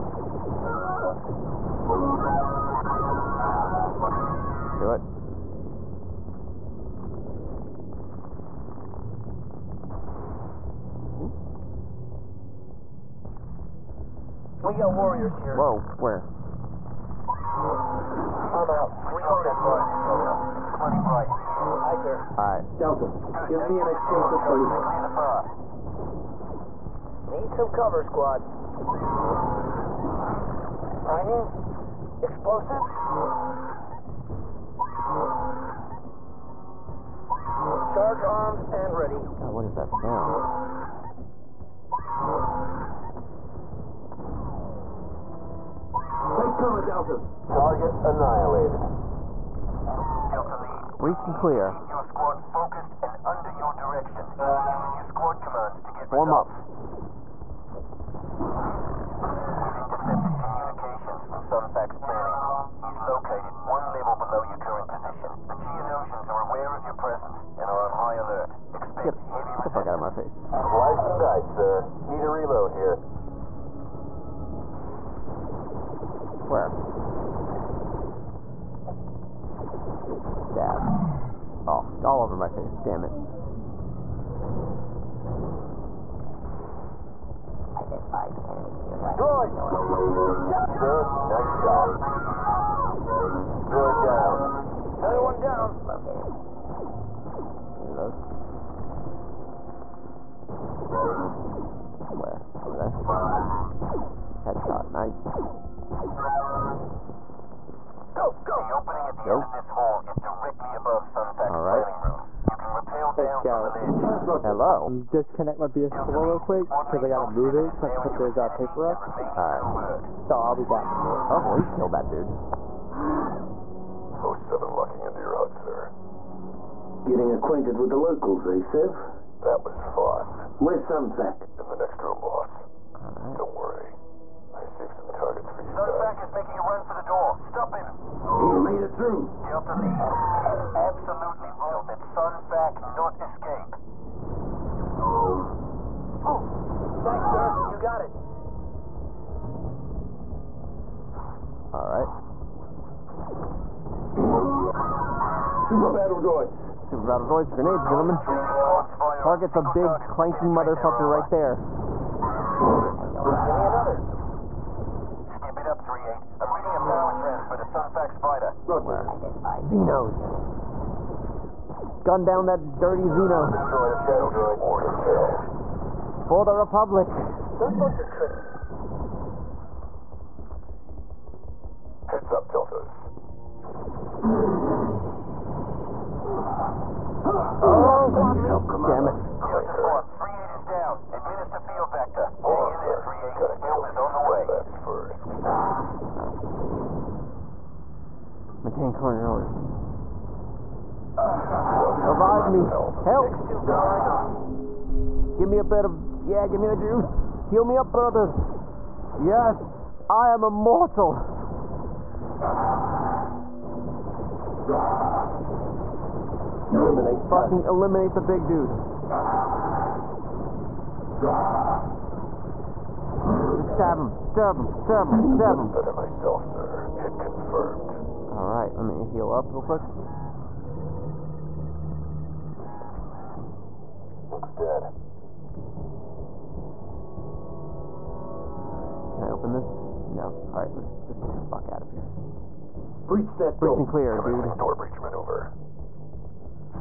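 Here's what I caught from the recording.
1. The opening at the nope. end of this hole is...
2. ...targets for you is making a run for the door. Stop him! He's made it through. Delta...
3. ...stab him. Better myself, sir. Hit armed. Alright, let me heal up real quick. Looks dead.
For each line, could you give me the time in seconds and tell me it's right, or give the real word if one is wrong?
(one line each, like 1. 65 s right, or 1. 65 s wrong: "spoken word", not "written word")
1. 108 s right
2. 135 s right
3. 225 s wrong: "confirmed", not "armed".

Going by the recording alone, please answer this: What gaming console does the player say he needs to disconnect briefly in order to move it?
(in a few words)
PS4.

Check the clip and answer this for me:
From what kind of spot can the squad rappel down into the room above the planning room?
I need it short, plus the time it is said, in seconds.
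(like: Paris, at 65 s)
The ledge, at 113 s.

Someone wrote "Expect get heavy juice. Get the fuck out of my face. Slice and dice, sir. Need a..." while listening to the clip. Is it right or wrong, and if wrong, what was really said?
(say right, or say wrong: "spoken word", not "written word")
wrong: "resistance", not "juice".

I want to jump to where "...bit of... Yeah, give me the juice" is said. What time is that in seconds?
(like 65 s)
205 s.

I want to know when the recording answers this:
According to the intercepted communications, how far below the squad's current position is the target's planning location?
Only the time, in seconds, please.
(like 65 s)
63 s.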